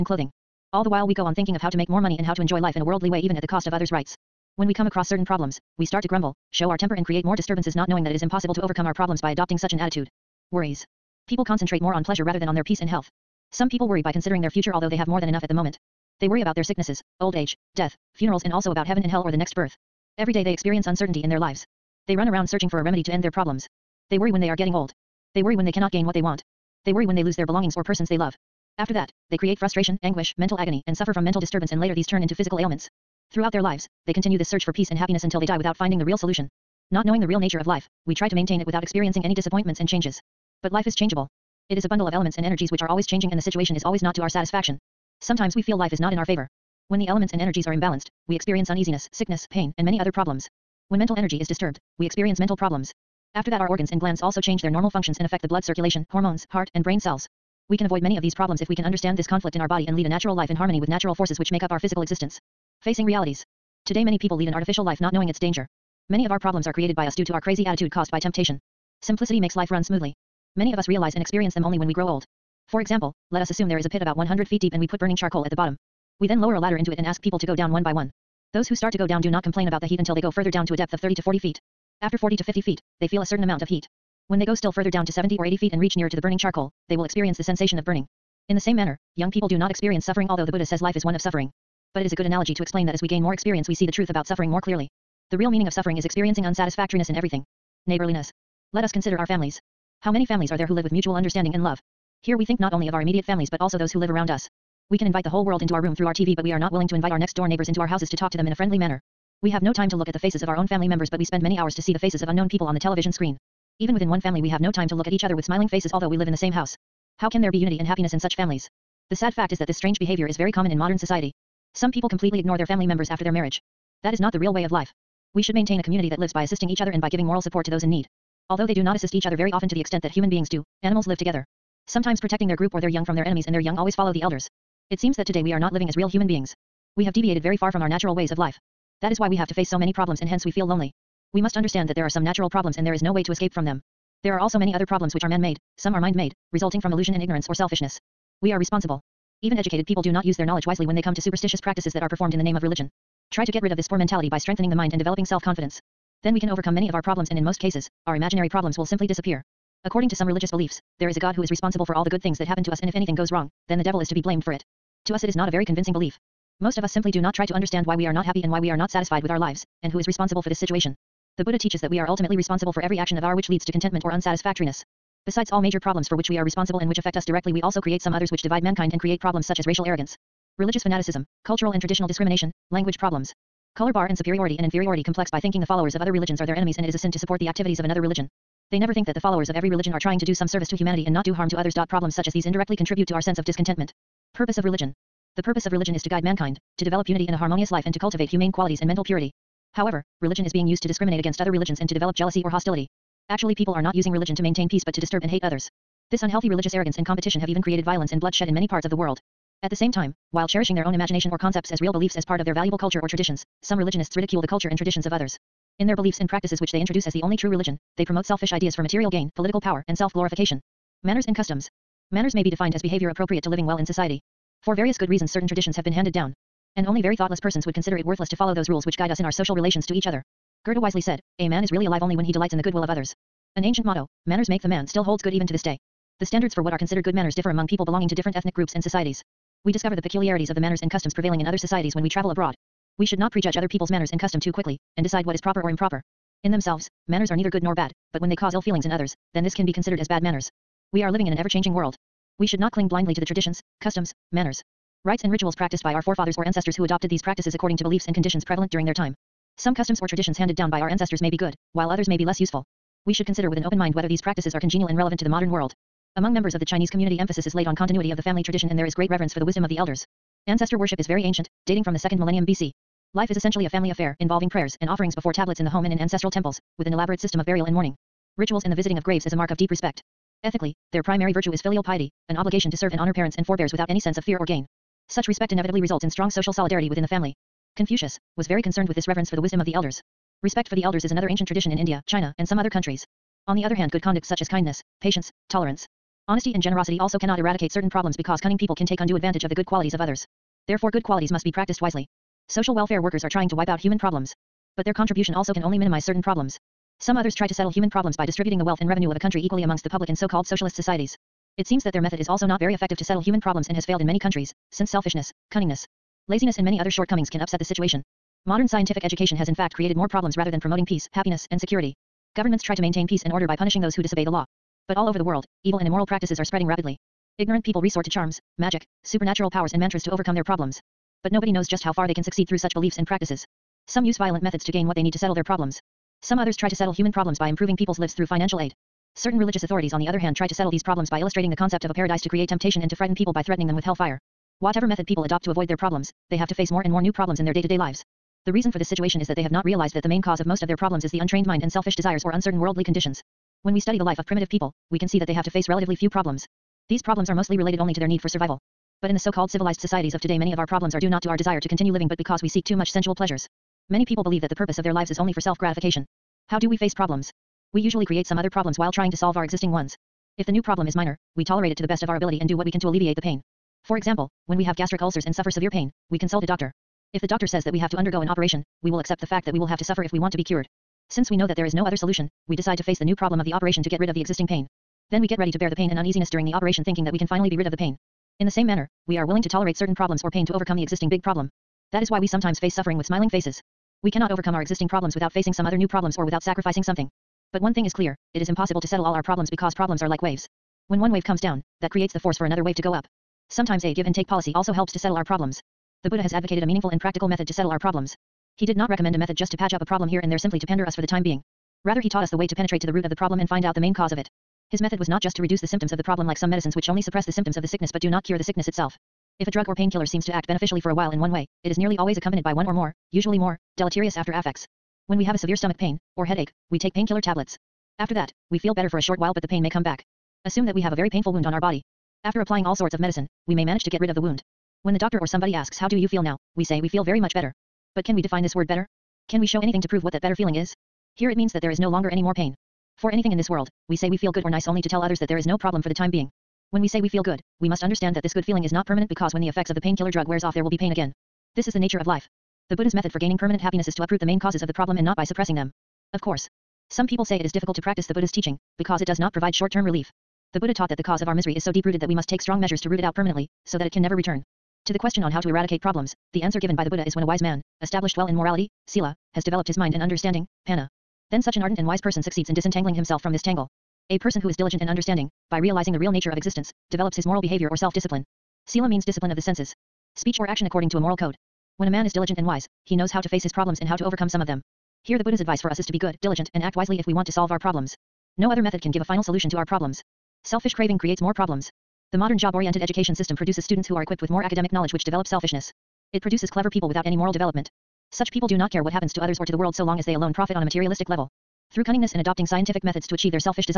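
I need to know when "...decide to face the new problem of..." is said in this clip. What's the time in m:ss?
6:22.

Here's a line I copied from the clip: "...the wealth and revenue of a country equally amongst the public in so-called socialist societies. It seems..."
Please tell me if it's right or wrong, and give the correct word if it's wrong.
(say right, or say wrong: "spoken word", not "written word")
right.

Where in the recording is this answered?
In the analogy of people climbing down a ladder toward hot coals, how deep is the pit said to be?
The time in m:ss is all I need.
1:14.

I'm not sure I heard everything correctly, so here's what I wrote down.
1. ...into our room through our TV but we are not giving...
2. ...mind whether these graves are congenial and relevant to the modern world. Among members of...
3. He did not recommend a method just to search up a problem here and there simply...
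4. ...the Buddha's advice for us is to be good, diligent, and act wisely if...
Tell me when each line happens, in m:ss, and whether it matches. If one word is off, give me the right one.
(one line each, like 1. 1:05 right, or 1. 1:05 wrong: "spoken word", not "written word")
1. 1:45 wrong: "willing", not "giving"
2. 4:23 wrong: "practices", not "graves"
3. 6:48 wrong: "patch", not "search"
4. 8:05 right.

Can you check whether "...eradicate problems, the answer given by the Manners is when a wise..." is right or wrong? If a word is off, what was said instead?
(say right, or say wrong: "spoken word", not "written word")
wrong: "Buddha", not "Manners".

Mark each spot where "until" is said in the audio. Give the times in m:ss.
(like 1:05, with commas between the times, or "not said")
0:35, 1:19.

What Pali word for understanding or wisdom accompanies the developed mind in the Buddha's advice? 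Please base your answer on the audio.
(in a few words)
Panna.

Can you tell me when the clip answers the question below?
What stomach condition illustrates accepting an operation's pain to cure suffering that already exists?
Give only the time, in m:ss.
6:14.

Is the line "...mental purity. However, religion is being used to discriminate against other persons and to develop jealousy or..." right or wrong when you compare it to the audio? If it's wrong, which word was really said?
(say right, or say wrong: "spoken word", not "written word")
wrong: "religions", not "persons".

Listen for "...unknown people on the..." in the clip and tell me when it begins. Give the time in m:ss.
1:52.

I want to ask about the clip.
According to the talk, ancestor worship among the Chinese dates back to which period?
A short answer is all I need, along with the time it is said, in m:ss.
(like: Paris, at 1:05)
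2nd millennium BC, at 4:31.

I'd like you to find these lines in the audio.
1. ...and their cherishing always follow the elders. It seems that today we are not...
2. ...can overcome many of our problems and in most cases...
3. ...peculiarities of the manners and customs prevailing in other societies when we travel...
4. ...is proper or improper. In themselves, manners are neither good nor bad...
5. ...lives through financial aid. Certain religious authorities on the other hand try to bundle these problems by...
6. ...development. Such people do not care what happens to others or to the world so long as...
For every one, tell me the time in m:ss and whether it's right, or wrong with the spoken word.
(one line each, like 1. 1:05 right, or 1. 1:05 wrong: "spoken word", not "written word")
1. 2:13 wrong: "young", not "cherishing"
2. 2:36 right
3. 4:00 right
4. 4:05 right
5. 5:37 wrong: "settle", not "bundle"
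6. 8:17 right.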